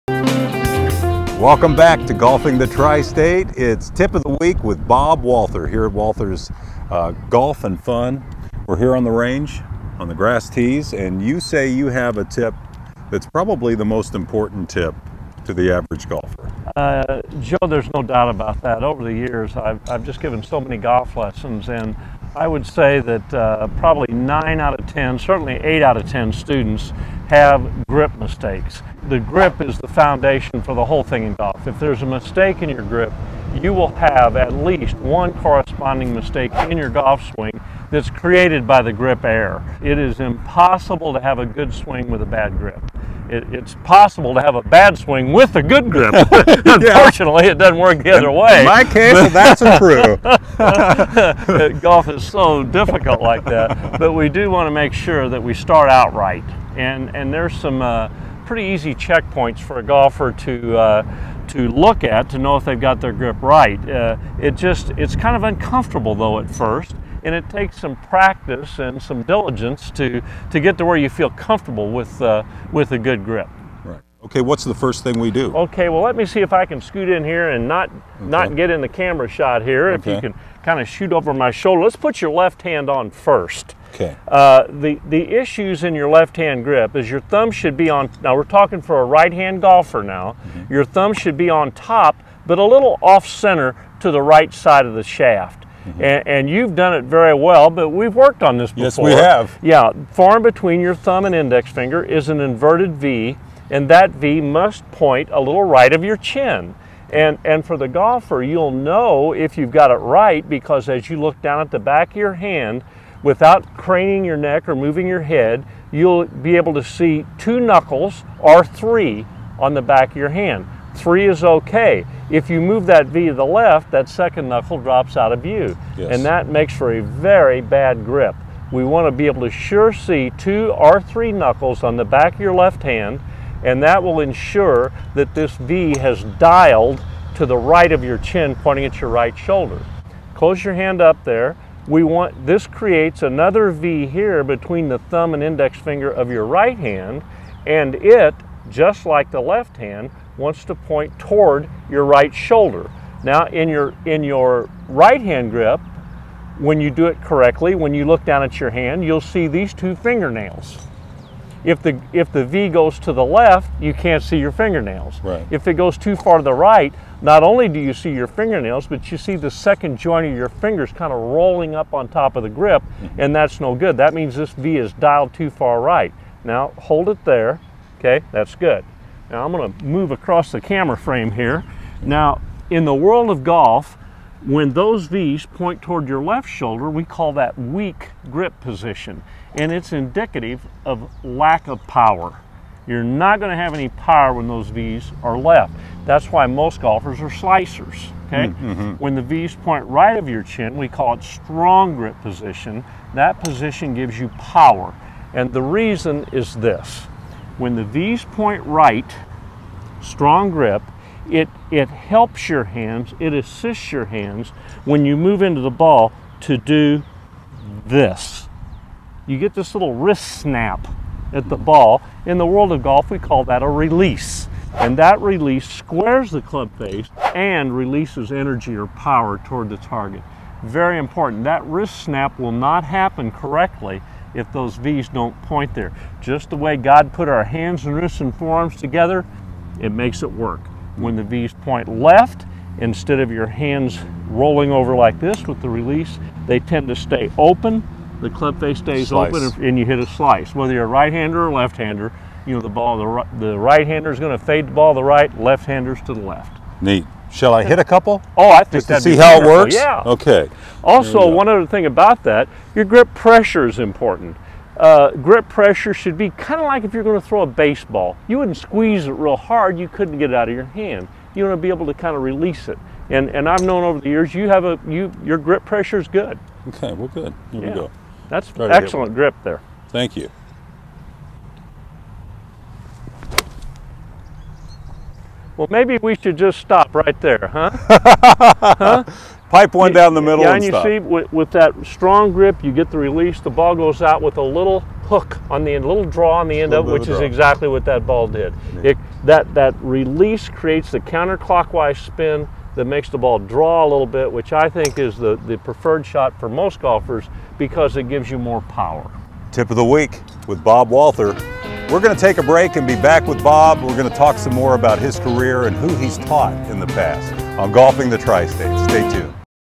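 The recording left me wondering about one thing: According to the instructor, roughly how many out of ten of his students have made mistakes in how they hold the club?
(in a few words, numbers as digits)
9.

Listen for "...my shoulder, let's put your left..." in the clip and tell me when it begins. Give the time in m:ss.
1:21.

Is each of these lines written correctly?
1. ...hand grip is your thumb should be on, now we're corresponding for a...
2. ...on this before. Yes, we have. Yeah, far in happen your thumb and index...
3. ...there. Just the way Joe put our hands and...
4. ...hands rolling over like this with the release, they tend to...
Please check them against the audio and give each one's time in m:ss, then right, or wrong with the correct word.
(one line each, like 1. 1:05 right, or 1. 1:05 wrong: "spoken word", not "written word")
1. 1:26 wrong: "talking", not "corresponding"
2. 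1:38 wrong: "between", not "happen"
3. 3:55 wrong: "God", not "Joe"
4. 4:03 right.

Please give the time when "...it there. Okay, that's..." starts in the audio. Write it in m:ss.
2:57.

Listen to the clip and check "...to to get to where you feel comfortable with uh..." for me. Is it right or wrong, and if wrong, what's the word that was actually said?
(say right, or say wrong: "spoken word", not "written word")
right.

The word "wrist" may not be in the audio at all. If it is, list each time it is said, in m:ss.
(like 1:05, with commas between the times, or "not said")
3:39, 3:51, 3:57.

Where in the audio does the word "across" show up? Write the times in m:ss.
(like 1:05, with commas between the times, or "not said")
3:00.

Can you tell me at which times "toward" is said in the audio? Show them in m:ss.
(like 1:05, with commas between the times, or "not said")
2:31, 3:05, 3:49.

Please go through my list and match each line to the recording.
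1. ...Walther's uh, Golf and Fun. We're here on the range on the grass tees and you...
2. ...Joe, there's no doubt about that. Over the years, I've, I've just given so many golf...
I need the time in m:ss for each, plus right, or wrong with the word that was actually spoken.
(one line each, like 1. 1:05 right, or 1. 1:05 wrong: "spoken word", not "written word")
1. 0:05 right
2. 0:17 right.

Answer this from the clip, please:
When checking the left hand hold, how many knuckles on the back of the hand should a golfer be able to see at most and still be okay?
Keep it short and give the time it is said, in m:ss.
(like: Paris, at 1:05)
3, at 2:00.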